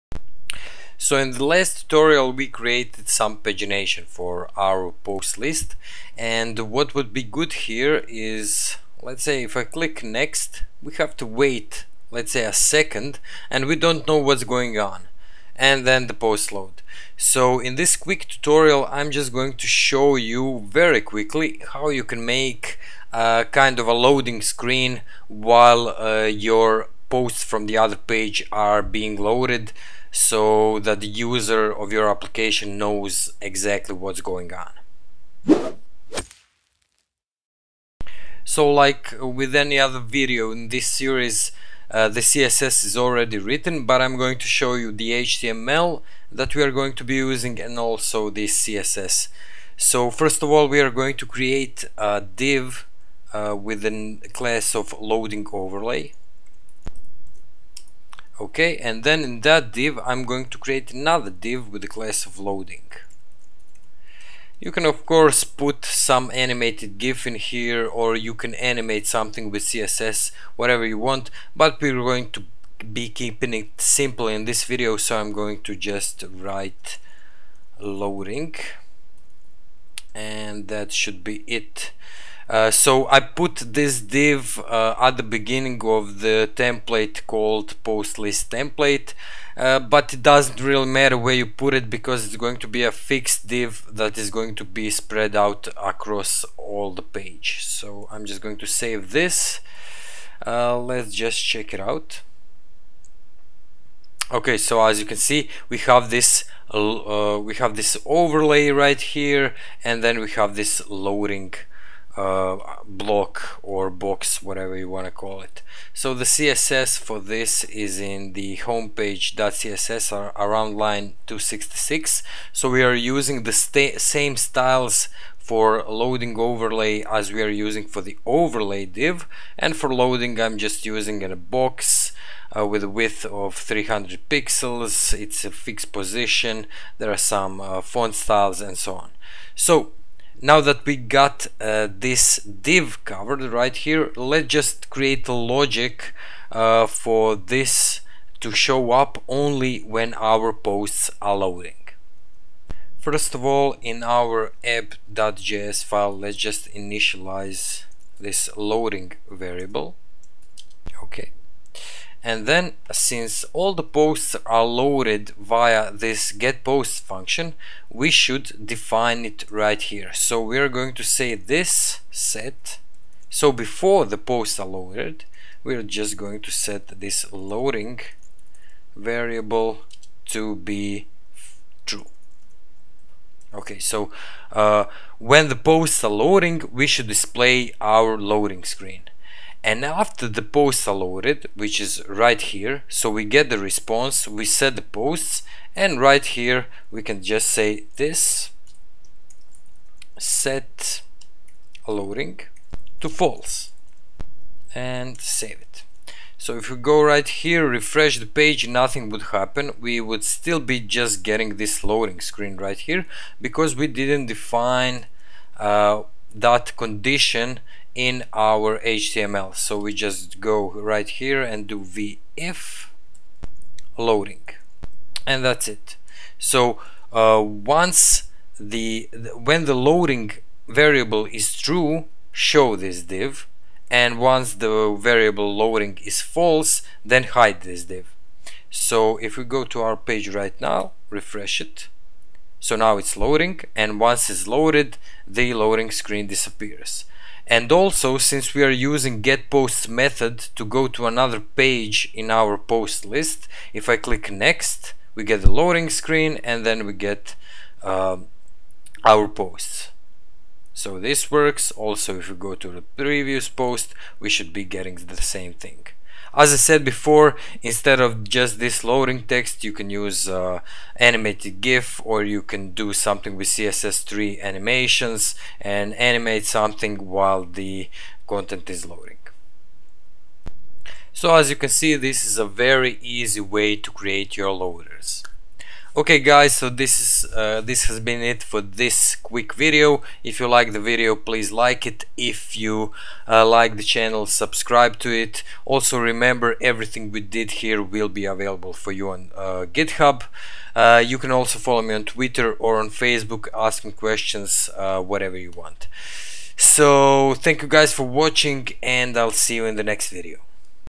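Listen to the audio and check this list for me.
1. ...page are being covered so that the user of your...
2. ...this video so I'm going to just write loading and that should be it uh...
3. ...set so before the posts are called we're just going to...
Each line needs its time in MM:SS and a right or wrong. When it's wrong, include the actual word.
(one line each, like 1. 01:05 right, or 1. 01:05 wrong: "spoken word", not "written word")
1. 00:27 wrong: "loaded", not "covered"
2. 01:14 right
3. 02:52 wrong: "loaded", not "called".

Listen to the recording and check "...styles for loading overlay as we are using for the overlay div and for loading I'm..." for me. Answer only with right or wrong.
right.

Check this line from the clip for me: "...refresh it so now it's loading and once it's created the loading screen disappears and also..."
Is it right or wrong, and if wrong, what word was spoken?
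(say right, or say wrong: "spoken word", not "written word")
wrong: "loaded", not "created".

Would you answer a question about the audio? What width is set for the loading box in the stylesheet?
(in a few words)
300 pixels.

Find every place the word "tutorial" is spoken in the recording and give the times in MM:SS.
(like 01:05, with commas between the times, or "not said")
00:01, 00:18.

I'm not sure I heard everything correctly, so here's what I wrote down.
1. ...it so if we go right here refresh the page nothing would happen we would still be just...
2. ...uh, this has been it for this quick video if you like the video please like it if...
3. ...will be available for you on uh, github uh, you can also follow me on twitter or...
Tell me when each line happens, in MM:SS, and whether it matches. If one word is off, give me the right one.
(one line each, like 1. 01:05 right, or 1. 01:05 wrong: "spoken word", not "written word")
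1. 03:25 right
2. 04:47 right
3. 04:57 right.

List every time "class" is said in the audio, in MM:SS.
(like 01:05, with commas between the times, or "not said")
00:54, 01:01.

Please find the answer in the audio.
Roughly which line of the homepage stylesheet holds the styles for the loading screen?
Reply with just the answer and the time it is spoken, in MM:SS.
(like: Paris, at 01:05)
266, at 02:01.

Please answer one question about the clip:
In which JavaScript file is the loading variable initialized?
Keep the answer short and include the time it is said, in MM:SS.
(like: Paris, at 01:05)
app.js, at 02:34.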